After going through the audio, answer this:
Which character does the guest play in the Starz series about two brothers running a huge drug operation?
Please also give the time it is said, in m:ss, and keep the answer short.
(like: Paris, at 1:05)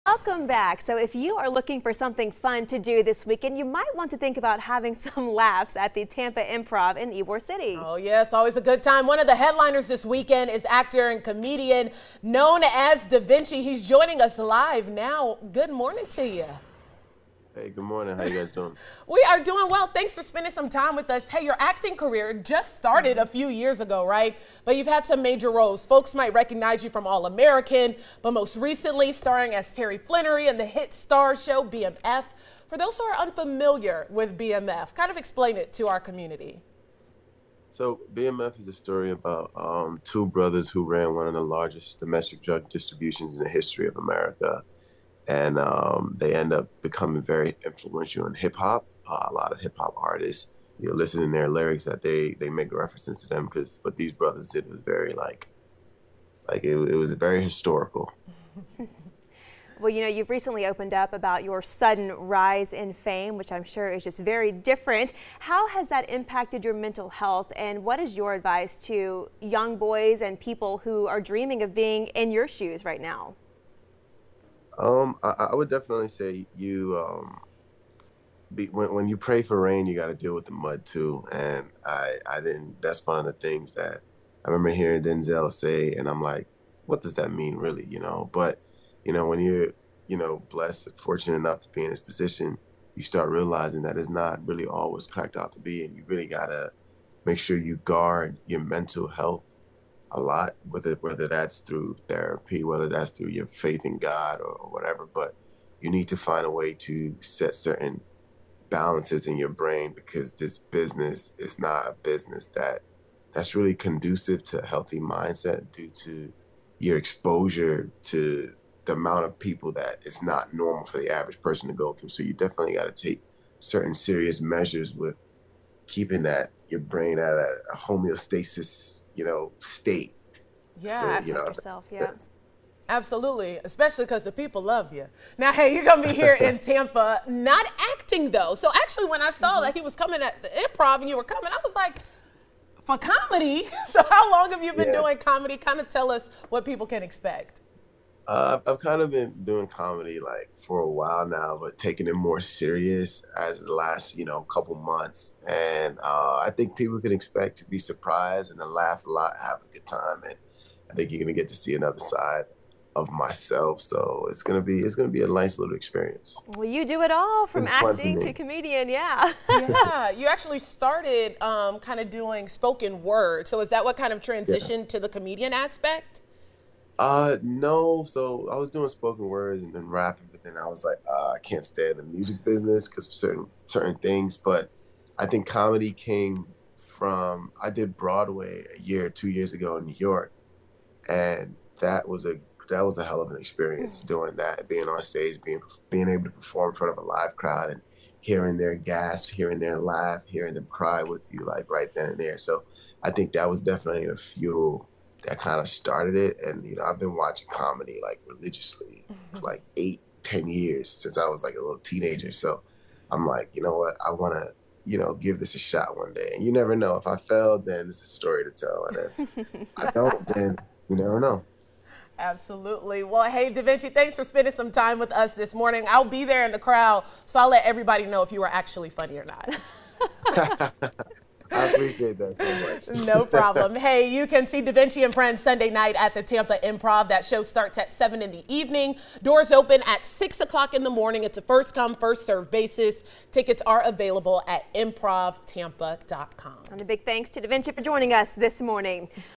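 Terry Flenory, at 0:29.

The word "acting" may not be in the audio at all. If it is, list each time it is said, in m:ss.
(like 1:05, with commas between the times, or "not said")
0:21, 2:17, 2:47.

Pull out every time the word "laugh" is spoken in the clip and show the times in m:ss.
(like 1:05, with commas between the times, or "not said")
0:05, 2:38, 3:19.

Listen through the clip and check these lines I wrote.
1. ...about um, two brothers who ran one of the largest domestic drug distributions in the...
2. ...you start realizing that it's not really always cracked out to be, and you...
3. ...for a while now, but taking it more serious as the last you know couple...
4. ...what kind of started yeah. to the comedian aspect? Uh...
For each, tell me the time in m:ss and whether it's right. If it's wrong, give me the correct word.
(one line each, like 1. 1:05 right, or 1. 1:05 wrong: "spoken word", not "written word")
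1. 0:39 right
2. 1:32 right
3. 2:30 right
4. 2:53 wrong: "transitioned", not "started".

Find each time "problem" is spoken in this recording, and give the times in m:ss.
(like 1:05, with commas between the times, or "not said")
3:53.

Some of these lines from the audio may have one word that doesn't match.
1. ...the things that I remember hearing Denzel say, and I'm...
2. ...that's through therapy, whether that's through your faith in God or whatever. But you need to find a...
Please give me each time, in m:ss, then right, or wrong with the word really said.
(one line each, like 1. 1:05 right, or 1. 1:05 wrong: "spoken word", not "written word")
1. 1:23 right
2. 1:41 right.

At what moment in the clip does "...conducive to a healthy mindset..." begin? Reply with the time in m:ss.
1:53.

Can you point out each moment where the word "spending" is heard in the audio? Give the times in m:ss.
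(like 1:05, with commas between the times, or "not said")
0:20, 3:44.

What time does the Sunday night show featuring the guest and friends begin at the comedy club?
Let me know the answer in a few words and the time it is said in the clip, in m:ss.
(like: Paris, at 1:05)
7 in the evening, at 3:57.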